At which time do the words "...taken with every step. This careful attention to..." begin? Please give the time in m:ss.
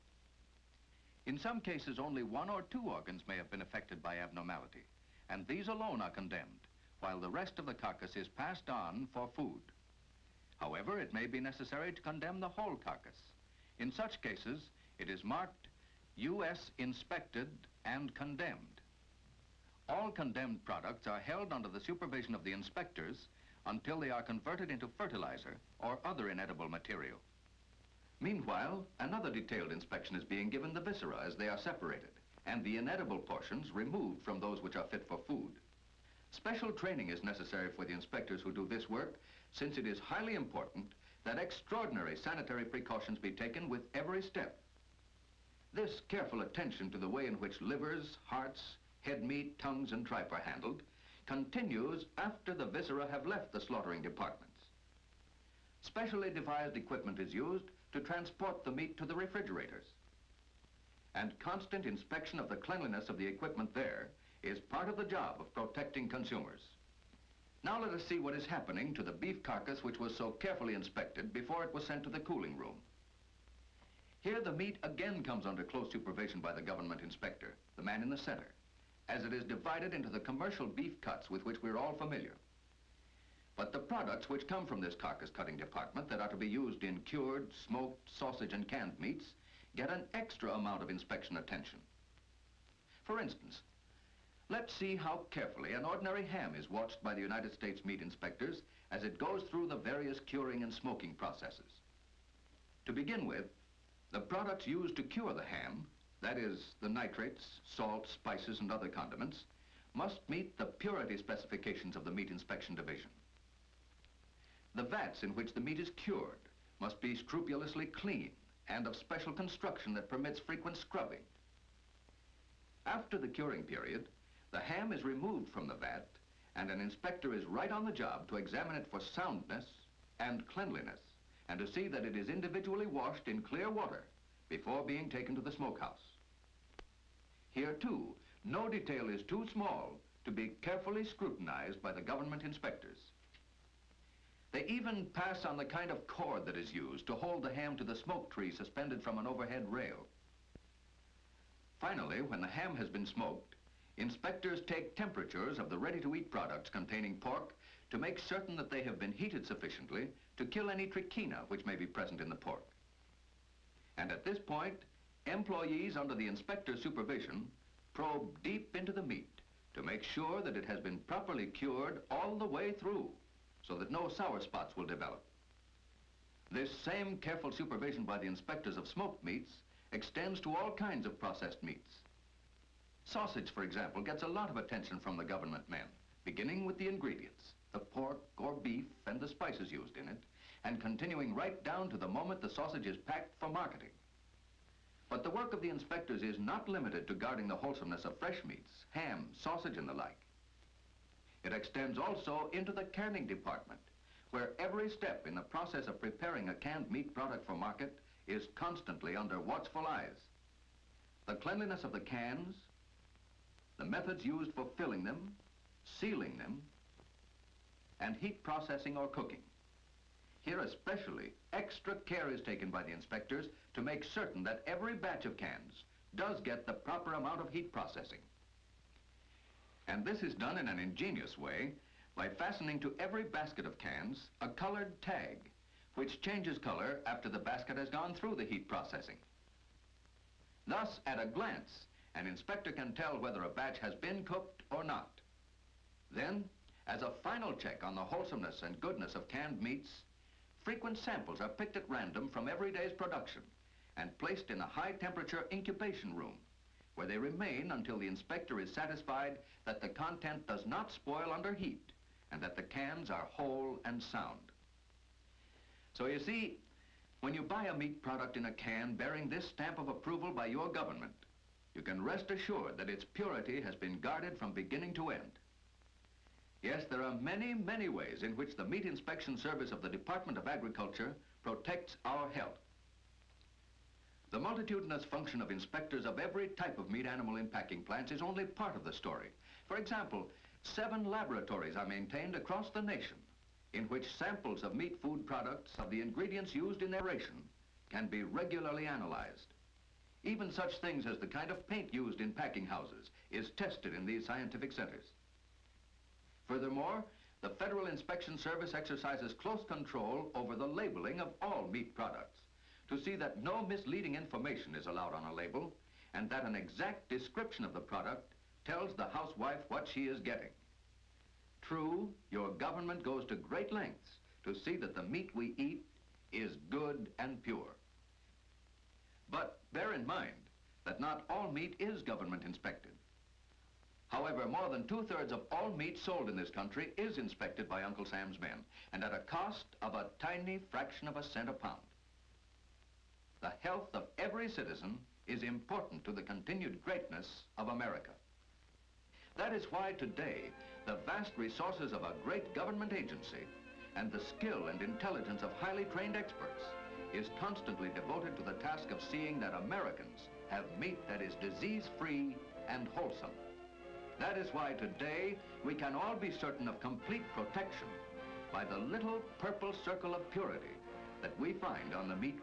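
0:43.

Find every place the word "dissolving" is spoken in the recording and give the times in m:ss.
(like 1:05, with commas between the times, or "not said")
not said.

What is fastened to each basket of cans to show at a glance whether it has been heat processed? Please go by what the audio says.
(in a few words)
A colored tag.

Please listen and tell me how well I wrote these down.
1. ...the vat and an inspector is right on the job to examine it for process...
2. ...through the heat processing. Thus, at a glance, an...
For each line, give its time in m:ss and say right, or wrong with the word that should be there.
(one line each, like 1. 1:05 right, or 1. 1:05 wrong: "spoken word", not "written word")
1. 2:05 wrong: "soundness", not "process"
2. 3:58 right.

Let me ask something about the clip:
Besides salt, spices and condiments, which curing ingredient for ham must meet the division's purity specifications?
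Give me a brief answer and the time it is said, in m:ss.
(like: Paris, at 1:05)
Nitrates, at 1:46.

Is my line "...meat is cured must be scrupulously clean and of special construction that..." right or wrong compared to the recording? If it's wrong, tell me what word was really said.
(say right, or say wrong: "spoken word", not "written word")
right.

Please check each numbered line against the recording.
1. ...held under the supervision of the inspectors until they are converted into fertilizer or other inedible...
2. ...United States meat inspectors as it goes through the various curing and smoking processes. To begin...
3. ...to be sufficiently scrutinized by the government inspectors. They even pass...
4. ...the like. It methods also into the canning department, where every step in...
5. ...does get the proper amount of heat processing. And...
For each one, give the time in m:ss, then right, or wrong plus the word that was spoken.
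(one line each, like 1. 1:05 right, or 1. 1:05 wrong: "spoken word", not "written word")
1. 0:21 right
2. 1:37 right
3. 2:20 wrong: "carefully", not "sufficiently"
4. 3:19 wrong: "extends", not "methods"
5. 3:46 right.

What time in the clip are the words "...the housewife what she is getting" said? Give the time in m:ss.
5:18.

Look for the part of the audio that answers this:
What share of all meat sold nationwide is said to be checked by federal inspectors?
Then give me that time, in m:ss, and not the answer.
5:34.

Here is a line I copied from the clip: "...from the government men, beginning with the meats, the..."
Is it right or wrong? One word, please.
wrong.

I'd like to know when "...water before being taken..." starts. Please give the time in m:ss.
2:13.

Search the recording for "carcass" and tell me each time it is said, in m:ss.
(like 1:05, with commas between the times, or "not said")
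0:07, 0:12, 1:09, 1:24.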